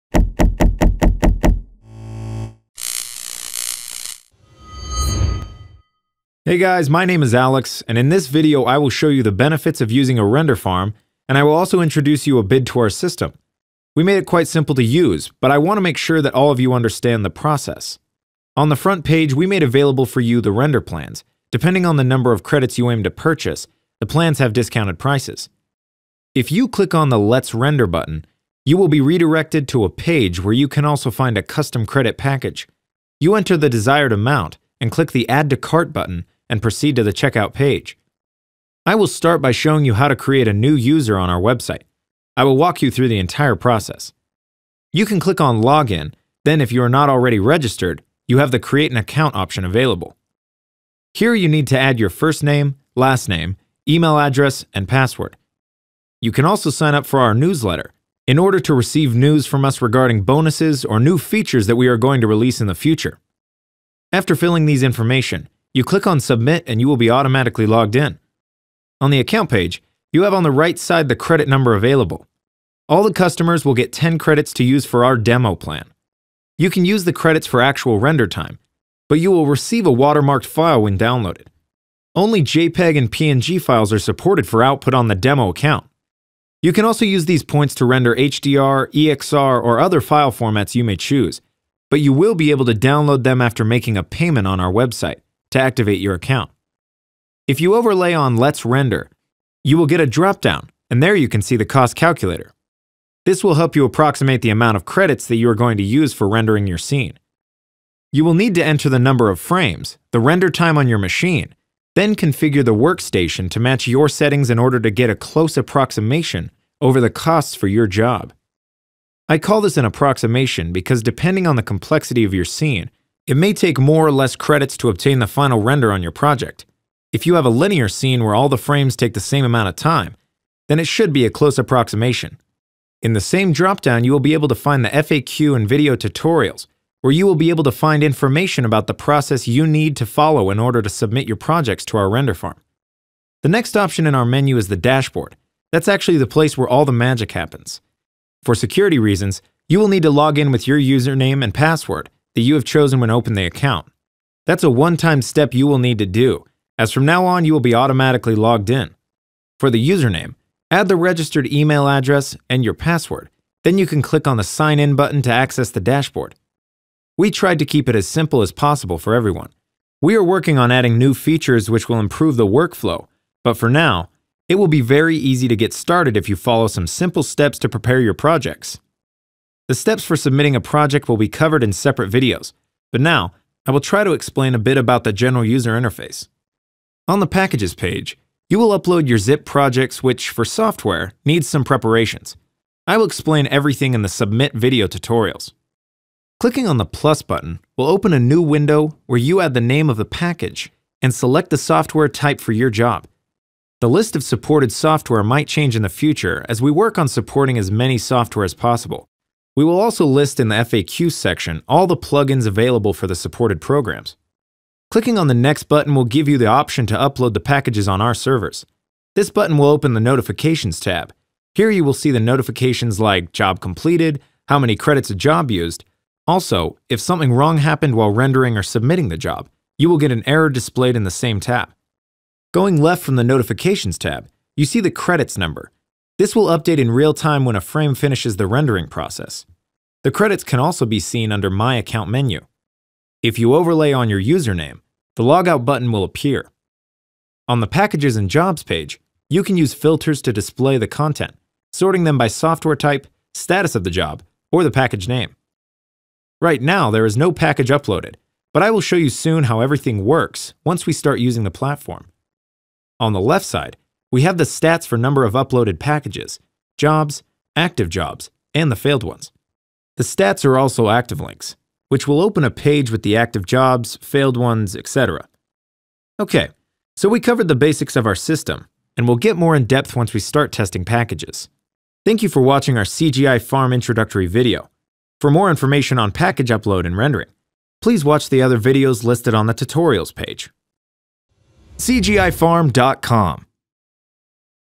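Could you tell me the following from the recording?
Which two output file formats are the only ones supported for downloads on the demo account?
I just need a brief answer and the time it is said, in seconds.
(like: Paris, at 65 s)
JPEG and PNG, at 82 s.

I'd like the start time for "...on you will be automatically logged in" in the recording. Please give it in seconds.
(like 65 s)
157 s.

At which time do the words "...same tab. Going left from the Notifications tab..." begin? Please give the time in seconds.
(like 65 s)
231 s.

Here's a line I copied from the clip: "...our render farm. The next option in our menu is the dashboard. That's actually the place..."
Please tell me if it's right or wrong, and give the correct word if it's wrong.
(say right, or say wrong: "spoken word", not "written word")
right.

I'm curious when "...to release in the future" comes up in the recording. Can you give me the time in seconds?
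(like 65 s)
62 s.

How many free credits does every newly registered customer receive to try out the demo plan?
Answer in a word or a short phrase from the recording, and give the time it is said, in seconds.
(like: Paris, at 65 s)
10, at 73 s.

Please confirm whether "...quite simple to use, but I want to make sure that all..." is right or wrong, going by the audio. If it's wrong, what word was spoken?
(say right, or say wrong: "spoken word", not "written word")
right.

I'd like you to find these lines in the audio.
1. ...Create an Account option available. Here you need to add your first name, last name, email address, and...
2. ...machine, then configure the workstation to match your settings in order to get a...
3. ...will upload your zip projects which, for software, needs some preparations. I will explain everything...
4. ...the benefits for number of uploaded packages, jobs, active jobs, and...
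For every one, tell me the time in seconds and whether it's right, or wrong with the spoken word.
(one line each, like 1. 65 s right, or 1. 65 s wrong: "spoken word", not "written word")
1. 48 s right
2. 110 s right
3. 188 s right
4. 264 s wrong: "stats", not "benefits".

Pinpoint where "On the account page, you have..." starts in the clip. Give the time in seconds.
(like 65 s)
68 s.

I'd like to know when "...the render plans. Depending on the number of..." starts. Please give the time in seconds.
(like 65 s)
20 s.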